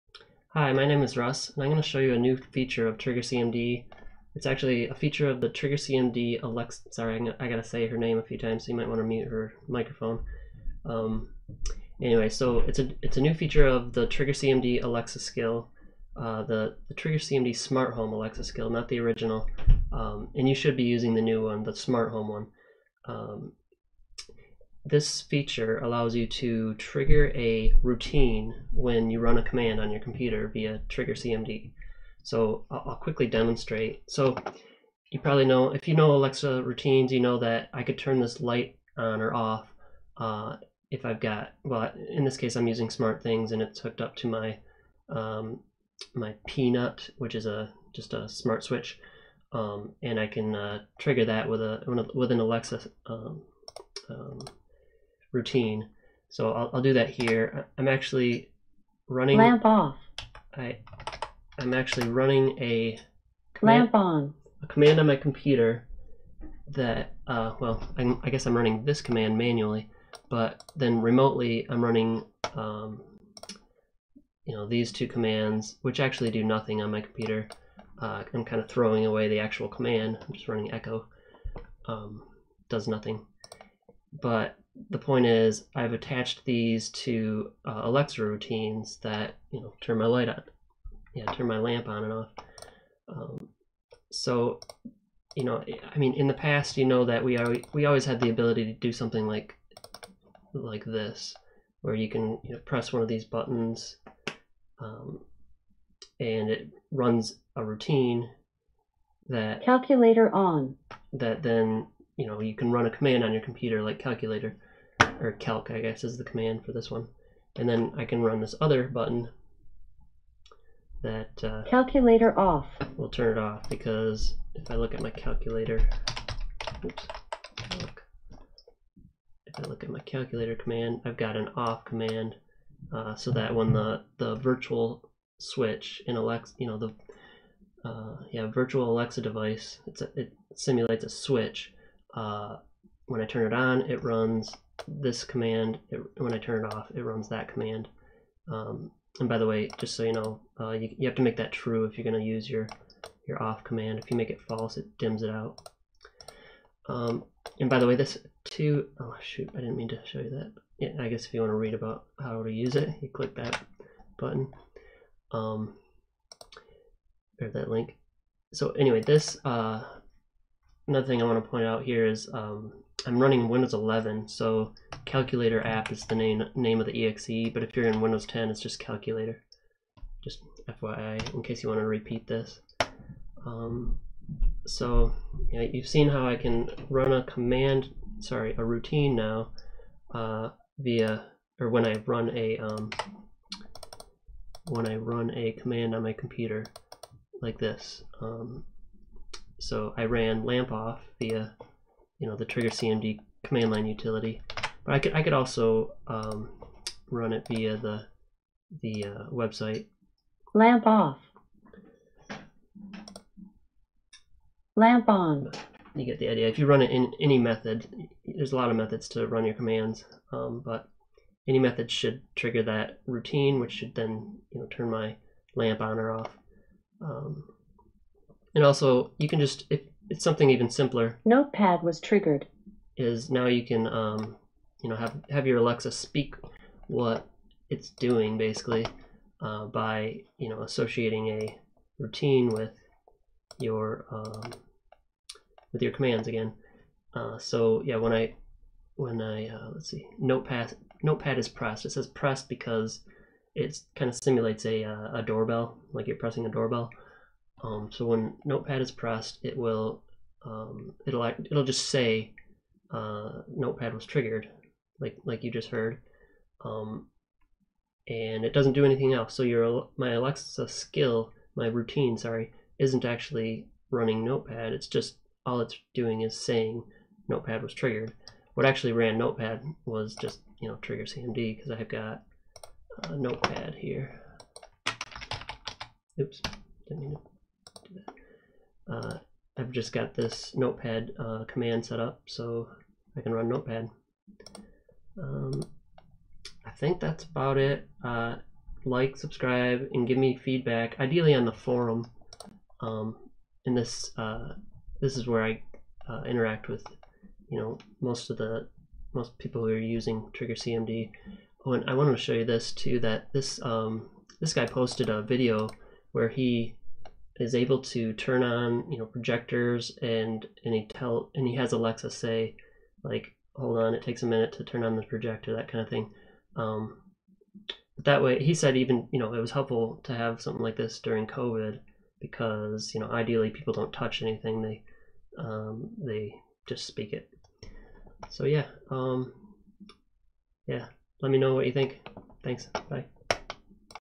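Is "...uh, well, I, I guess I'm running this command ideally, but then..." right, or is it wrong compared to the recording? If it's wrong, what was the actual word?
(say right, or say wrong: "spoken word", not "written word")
wrong: "manually", not "ideally".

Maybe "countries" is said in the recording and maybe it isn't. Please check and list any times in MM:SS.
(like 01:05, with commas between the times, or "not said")
not said.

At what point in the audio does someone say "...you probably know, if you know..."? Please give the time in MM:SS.
00:35.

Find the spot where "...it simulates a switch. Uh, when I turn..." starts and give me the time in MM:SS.
02:20.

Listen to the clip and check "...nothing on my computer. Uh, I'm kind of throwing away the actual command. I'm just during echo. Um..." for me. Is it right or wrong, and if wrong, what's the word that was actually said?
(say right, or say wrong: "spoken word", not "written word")
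wrong: "running", not "during".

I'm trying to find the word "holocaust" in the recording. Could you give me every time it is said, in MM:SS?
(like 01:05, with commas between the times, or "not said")
not said.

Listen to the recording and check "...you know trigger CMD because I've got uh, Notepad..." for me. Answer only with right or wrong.
right.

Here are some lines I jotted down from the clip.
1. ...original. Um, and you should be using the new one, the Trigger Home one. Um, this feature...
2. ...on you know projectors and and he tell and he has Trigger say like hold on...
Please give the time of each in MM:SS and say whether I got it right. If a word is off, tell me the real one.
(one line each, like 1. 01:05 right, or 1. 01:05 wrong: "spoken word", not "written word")
1. 00:18 wrong: "Smart", not "Trigger"
2. 05:18 wrong: "Alexa", not "Trigger".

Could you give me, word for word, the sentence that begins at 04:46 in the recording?
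Oops, didn't mean to uh, I've just got this notepad uh, command set up so I can run notepad.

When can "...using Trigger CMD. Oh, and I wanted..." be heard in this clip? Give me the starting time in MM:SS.
05:09.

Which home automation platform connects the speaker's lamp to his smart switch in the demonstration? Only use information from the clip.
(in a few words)
SmartThings.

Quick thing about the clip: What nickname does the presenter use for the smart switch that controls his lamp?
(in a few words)
peanut.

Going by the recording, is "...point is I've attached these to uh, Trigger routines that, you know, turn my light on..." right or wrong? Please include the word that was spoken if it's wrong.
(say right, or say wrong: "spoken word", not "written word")
wrong: "Alexa", not "Trigger".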